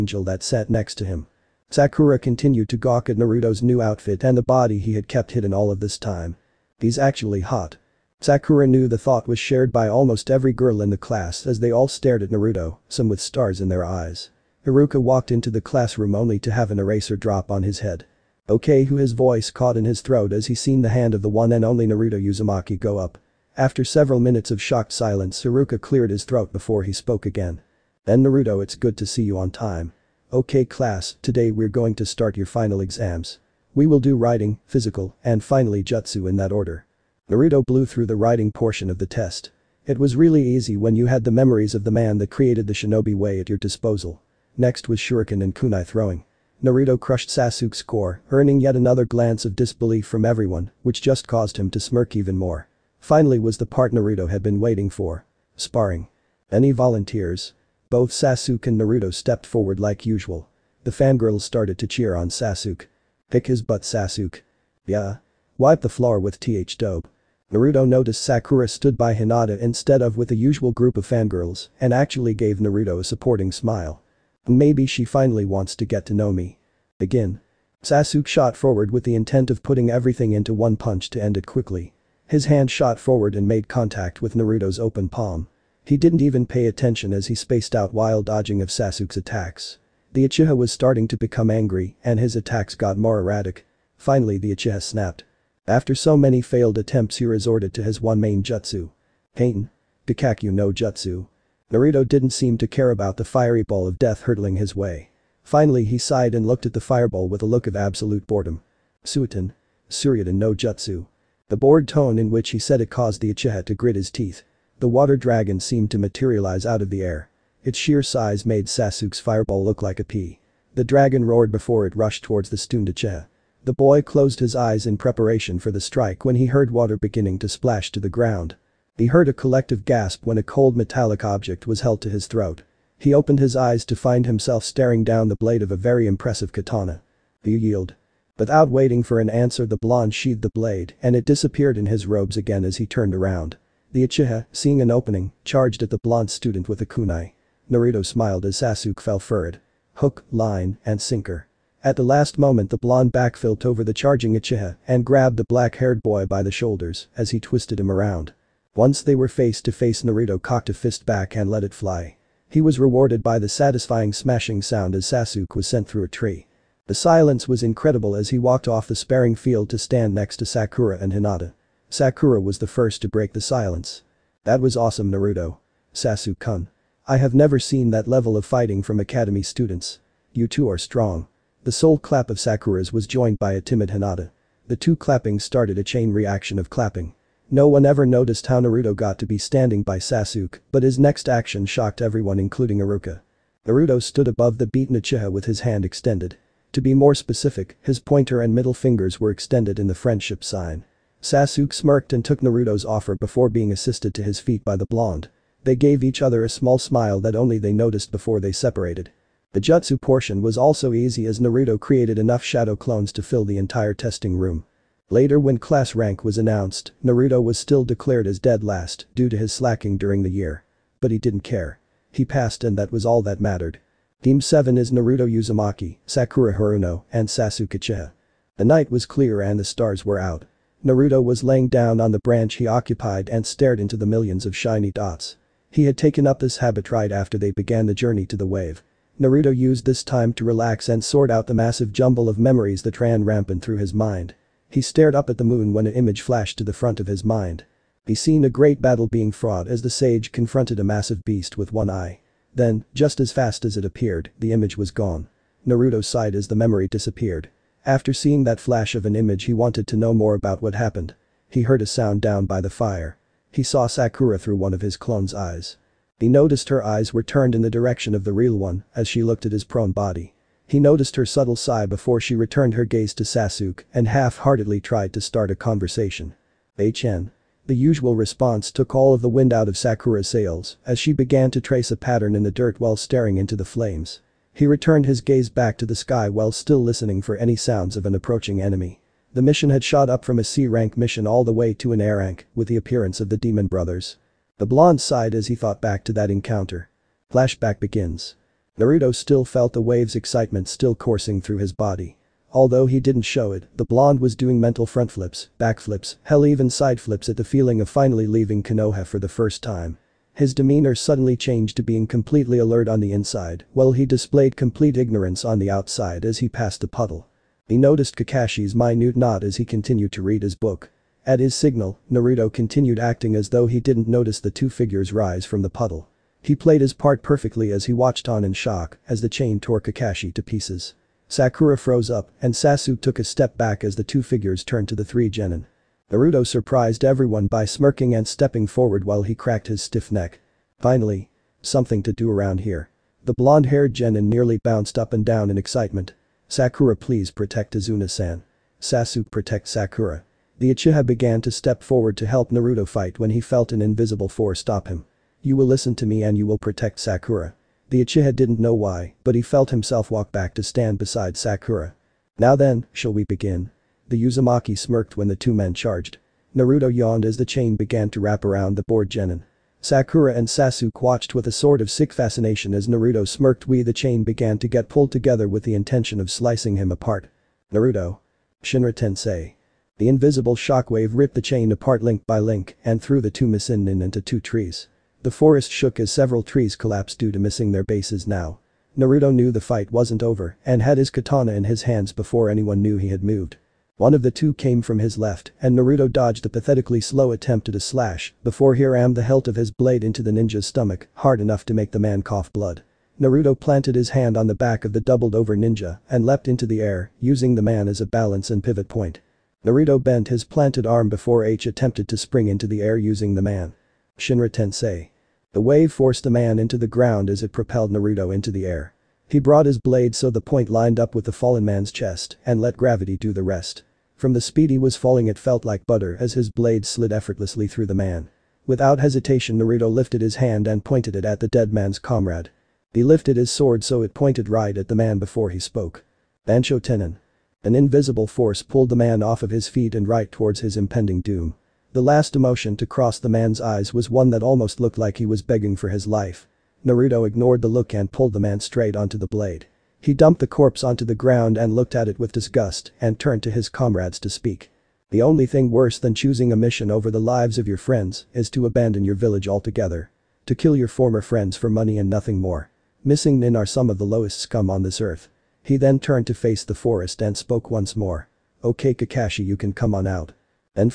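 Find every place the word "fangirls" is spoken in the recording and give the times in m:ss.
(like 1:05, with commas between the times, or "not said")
1:00, 1:11.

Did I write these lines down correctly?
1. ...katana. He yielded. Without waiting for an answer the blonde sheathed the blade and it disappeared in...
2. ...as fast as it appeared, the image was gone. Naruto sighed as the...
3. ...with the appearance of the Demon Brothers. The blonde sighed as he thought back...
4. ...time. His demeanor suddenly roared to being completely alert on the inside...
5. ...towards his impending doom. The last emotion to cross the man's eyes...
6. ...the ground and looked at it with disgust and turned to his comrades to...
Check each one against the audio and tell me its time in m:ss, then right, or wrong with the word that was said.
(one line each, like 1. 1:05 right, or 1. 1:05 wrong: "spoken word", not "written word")
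1. 2:16 right
2. 4:13 right
3. 4:52 right
4. 5:09 wrong: "changed", not "roared"
5. 7:20 right
6. 7:31 right.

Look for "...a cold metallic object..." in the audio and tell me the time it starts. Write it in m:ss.
2:10.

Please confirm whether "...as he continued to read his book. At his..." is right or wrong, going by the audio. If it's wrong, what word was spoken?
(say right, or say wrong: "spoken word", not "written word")
right.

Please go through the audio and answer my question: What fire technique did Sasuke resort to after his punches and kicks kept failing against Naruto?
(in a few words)
Goukakyuu no jutsu.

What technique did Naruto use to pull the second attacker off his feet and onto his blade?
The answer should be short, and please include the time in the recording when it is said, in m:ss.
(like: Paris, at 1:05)
Bansho Ten'in, at 7:16.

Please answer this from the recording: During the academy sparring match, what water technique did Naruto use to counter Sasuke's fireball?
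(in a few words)
Suiryudan no Jutsu.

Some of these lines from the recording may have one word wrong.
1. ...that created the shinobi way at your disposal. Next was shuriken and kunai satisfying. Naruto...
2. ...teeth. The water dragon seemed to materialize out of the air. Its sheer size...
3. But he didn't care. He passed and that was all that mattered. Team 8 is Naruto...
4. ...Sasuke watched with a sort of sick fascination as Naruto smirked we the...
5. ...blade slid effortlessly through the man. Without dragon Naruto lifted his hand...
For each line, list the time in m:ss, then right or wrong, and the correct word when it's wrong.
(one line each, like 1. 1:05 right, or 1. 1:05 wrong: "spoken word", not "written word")
1. 0:42 wrong: "throwing", not "satisfying"
2. 1:54 right
3. 3:41 wrong: "7", not "8"
4. 6:10 right
5. 7:06 wrong: "hesitation", not "dragon".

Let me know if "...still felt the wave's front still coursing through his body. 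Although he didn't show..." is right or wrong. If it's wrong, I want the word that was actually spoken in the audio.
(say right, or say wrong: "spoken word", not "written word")
wrong: "excitement", not "front".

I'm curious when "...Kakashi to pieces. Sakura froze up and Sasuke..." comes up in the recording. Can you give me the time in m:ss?
5:29.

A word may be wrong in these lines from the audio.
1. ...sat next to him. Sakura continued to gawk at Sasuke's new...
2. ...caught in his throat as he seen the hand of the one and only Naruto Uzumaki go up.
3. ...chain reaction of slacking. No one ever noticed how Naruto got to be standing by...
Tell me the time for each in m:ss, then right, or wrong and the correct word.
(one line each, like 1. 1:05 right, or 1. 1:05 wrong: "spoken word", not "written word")
1. 0:00 wrong: "Naruto", not "Sasuke"
2. 0:19 right
3. 3:05 wrong: "clapping", not "slacking".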